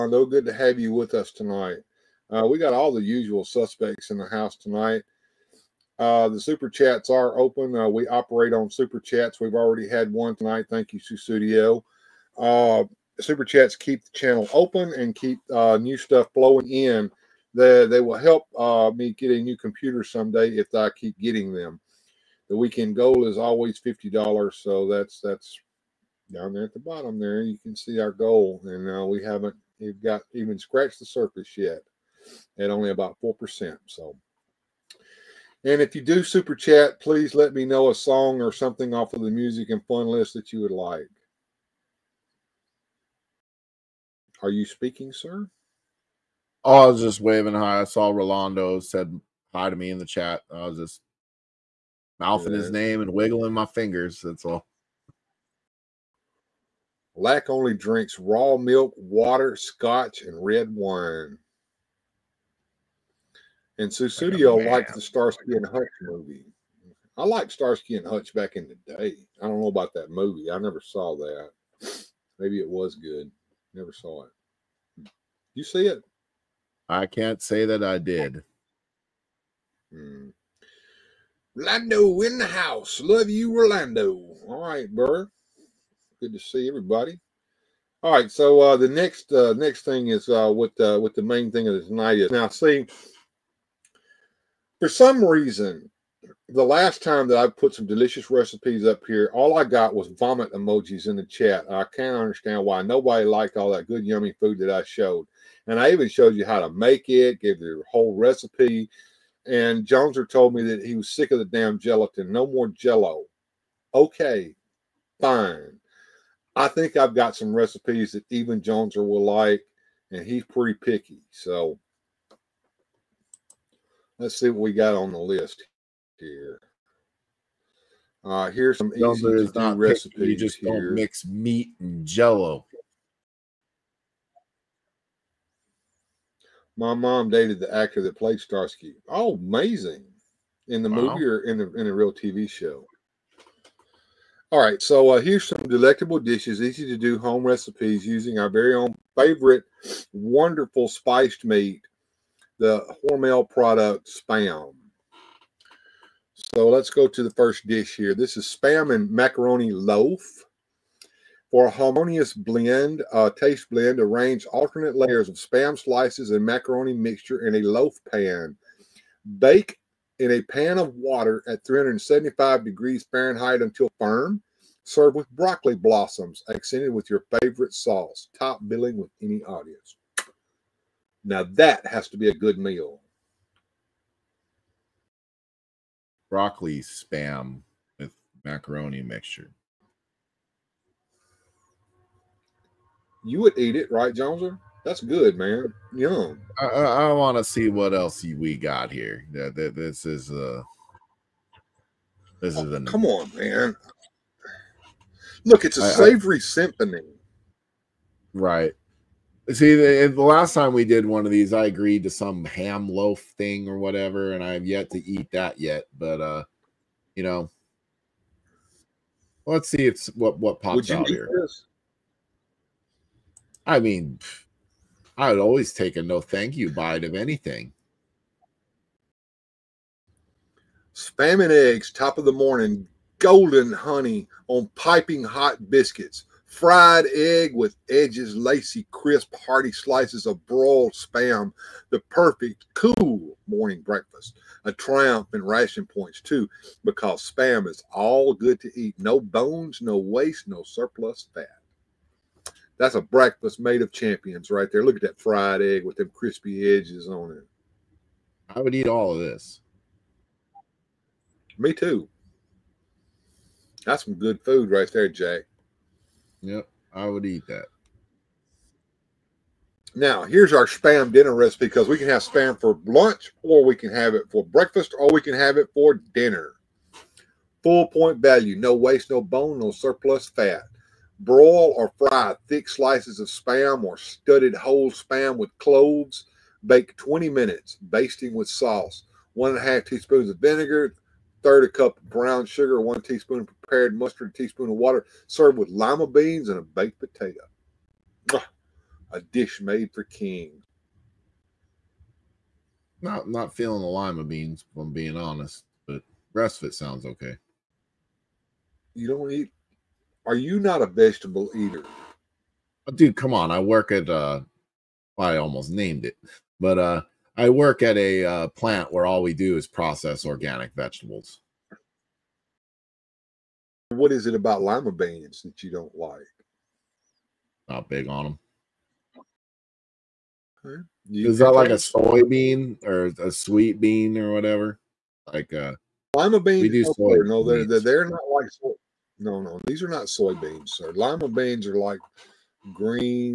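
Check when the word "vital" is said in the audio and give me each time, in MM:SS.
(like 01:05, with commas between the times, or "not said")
not said.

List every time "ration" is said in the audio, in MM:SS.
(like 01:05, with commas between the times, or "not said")
04:05.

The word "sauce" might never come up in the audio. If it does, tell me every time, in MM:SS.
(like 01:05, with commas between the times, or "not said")
02:57, 04:48.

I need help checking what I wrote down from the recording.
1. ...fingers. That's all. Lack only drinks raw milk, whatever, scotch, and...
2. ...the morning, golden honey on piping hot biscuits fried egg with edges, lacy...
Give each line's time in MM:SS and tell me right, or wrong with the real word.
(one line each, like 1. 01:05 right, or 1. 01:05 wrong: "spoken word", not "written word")
1. 00:53 wrong: "water", not "whatever"
2. 03:52 right.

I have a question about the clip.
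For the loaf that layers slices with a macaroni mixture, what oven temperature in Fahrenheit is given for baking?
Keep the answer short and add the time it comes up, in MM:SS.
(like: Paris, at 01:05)
375 degrees, at 02:51.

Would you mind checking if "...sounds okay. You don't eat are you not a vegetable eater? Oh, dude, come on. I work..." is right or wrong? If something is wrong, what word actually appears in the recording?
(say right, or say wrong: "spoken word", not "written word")
right.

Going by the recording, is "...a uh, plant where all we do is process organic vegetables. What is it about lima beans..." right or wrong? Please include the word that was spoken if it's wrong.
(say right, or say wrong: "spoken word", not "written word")
right.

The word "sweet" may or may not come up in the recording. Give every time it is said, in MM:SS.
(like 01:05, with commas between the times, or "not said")
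05:33.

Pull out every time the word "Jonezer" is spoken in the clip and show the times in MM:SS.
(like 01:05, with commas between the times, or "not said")
01:49, 01:58, 03:14.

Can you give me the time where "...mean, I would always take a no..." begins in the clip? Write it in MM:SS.
03:43.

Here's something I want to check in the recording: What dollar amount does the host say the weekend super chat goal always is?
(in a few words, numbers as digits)
$50.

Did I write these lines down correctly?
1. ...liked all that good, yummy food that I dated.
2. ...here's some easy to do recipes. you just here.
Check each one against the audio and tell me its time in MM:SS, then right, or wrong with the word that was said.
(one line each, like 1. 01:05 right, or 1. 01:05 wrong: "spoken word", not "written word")
1. 01:43 wrong: "showed", not "dated"
2. 02:08 right.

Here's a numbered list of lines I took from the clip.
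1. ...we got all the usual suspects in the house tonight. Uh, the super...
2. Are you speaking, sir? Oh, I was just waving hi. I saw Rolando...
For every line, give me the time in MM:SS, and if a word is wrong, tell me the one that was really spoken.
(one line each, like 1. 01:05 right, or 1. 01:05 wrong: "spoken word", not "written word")
1. 00:02 right
2. 00:44 right.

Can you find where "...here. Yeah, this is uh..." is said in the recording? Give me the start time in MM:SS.
03:18.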